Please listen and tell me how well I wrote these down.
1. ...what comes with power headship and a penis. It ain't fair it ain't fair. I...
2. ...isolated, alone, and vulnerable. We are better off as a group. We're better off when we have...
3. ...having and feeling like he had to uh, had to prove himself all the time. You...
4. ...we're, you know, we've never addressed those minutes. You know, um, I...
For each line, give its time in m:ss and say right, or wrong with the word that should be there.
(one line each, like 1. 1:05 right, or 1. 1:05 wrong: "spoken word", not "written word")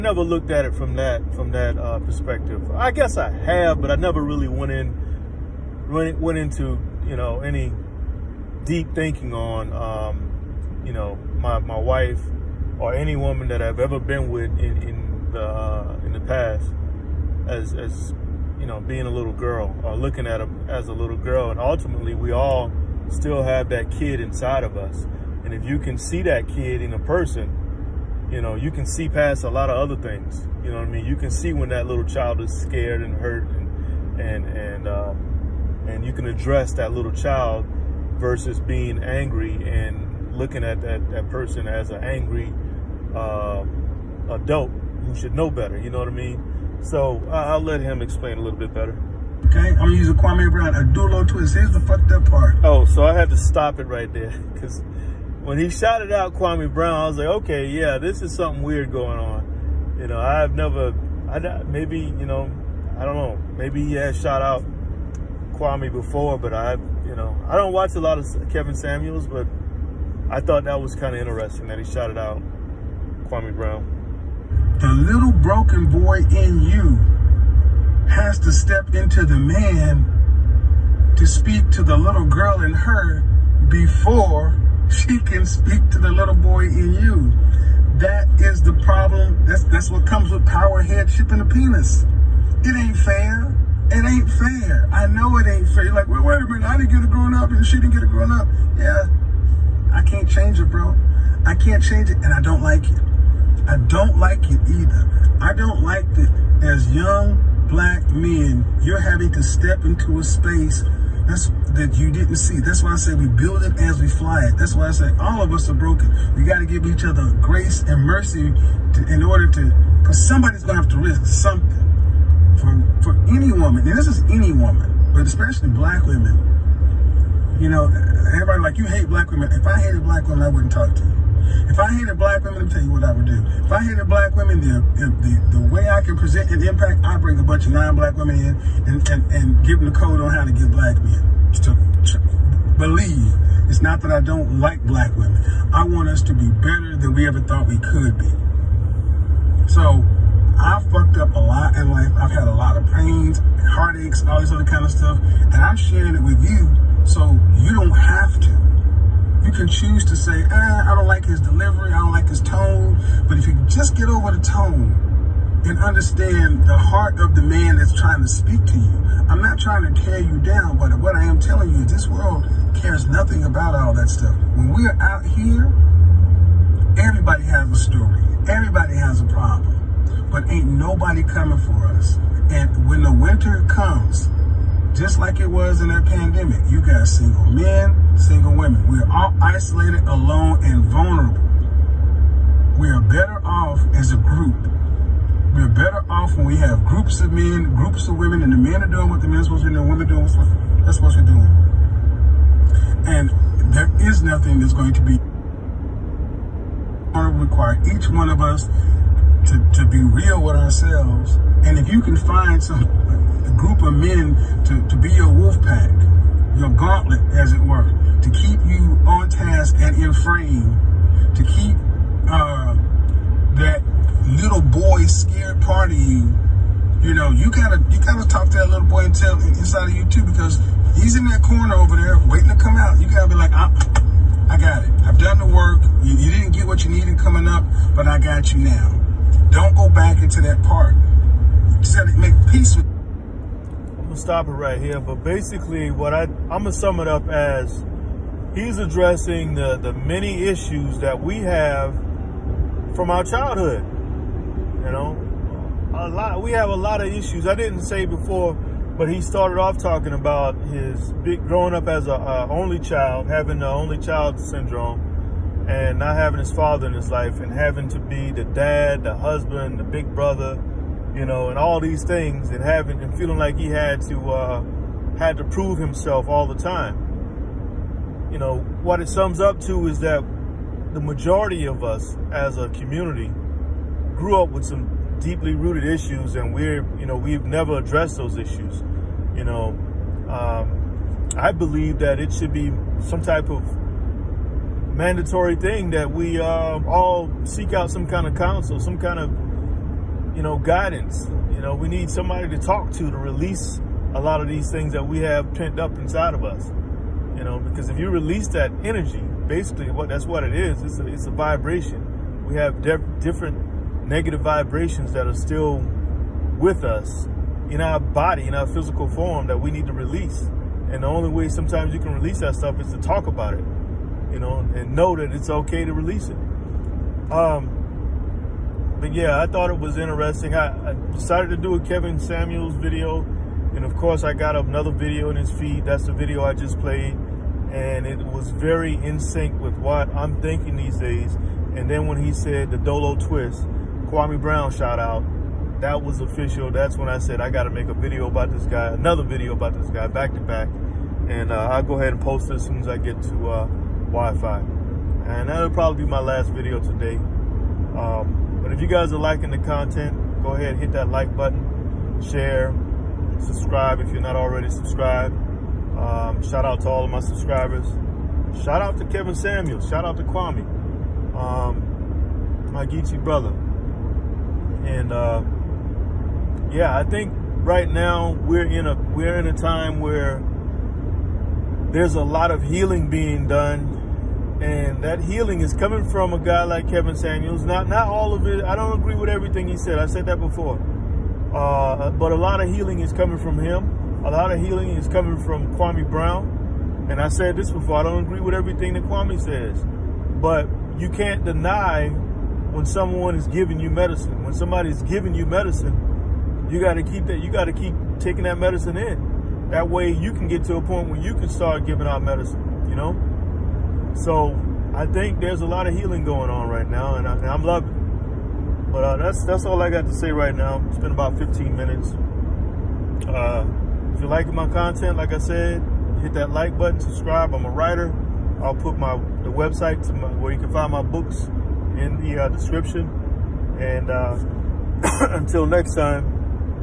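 1. 1:29 right
2. 3:09 right
3. 4:32 right
4. 4:46 wrong: "issues", not "minutes".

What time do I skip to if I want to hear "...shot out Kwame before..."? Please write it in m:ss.
1:04.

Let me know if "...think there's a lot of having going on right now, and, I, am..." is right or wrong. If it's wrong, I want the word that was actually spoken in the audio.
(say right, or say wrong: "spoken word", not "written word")
wrong: "healing", not "having".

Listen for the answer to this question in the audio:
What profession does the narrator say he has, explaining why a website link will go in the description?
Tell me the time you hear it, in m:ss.
7:07.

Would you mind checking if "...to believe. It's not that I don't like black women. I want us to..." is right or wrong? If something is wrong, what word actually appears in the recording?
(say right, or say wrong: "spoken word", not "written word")
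right.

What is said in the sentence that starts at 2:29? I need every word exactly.
So I've fucked up a lot in life.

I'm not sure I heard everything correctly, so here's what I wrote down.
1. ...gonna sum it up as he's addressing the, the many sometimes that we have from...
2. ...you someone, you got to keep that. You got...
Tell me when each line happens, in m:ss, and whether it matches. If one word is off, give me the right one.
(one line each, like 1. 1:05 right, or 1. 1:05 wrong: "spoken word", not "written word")
1. 4:06 wrong: "issues", not "sometimes"
2. 6:45 wrong: "medicine", not "someone".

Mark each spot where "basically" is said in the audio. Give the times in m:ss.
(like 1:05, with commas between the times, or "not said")
4:05, 5:09.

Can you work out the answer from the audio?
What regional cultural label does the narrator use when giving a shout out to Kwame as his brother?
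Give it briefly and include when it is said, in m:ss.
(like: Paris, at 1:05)
Geechee, at 6:12.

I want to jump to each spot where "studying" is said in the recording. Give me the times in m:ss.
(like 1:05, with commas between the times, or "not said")
not said.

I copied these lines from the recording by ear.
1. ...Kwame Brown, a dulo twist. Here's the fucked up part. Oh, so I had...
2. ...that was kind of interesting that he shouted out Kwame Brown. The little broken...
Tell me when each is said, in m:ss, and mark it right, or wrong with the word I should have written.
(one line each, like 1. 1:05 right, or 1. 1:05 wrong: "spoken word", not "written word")
1. 0:50 right
2. 1:10 right.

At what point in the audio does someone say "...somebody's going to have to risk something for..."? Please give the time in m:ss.
2:00.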